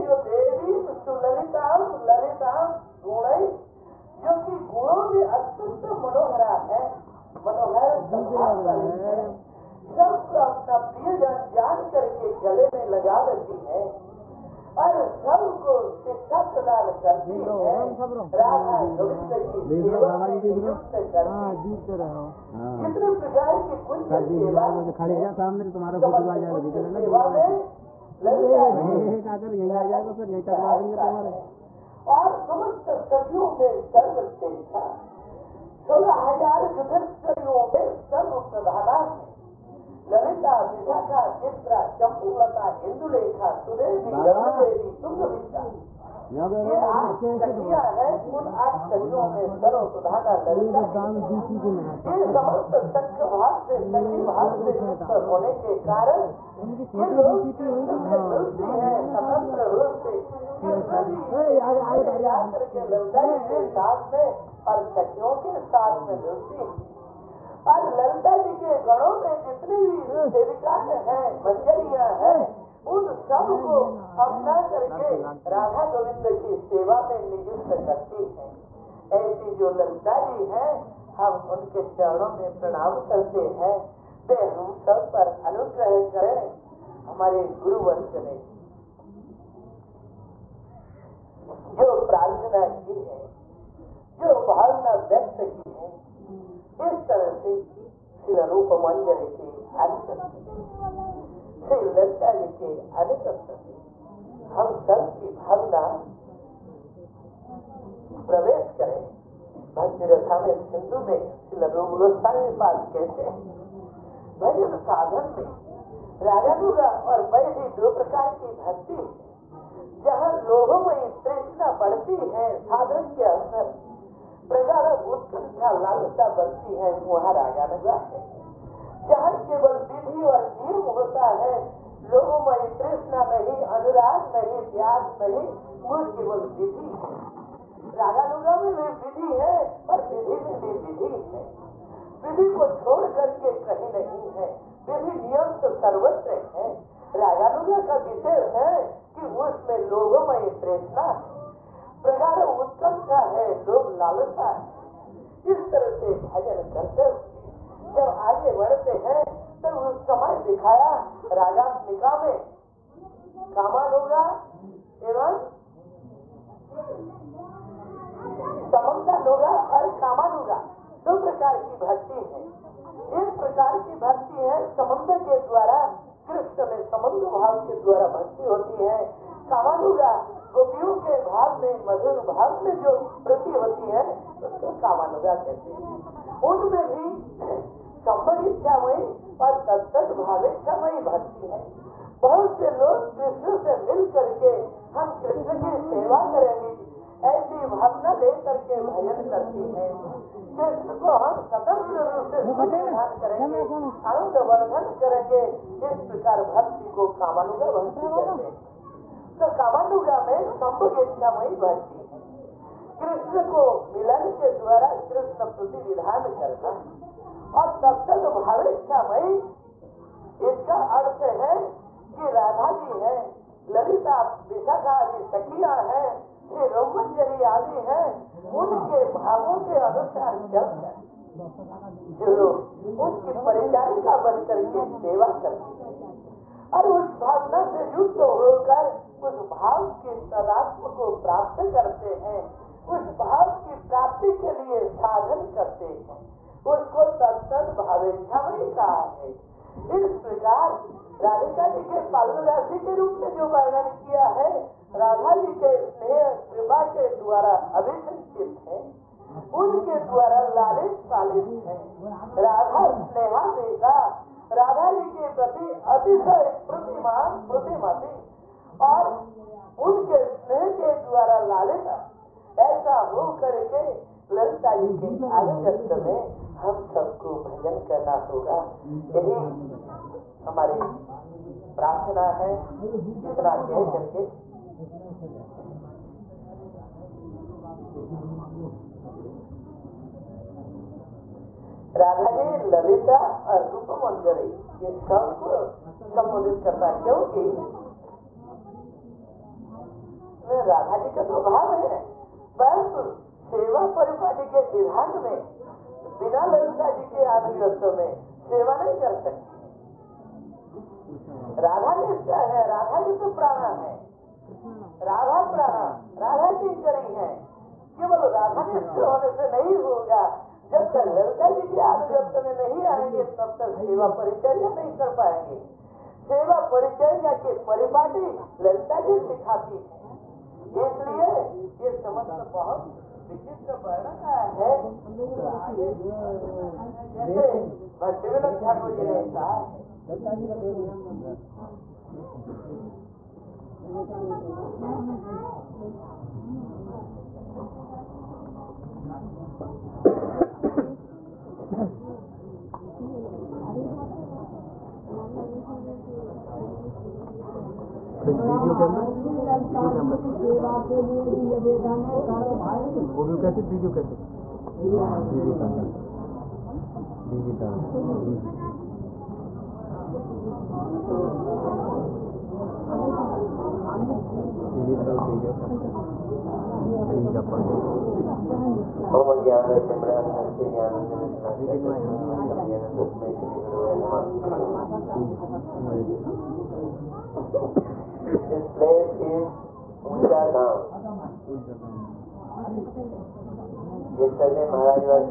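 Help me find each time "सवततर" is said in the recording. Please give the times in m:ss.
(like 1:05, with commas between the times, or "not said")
0:59, 3:21.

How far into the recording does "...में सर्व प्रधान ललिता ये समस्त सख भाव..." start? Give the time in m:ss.
0:49.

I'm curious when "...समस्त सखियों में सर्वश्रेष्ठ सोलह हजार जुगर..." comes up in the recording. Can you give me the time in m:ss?
0:32.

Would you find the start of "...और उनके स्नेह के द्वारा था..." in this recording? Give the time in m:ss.
4:28.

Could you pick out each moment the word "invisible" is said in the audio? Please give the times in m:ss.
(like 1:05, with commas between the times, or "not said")
not said.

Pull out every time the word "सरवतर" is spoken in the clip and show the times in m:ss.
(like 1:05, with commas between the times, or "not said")
2:25.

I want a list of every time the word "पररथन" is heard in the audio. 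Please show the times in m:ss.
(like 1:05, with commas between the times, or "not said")
1:32, 4:41.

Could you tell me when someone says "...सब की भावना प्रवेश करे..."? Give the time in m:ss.
1:44.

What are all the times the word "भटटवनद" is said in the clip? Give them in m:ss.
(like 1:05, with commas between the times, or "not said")
5:38.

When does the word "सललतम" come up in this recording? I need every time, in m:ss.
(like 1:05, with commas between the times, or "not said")
0:01.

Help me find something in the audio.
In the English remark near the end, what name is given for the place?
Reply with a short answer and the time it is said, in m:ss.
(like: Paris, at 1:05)
Unjagam, at 6:30.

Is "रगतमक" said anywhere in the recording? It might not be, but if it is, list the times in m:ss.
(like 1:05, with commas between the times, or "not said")
2:41.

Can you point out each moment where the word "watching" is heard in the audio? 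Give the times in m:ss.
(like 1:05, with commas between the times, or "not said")
not said.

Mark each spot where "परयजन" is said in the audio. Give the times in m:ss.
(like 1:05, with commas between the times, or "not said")
0:10.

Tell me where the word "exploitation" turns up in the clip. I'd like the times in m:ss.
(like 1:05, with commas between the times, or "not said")
not said.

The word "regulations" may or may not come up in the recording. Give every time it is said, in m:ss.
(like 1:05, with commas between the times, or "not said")
not said.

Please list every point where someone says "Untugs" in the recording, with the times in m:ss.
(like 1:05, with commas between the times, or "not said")
not said.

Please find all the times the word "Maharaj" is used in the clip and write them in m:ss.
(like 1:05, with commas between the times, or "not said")
6:34.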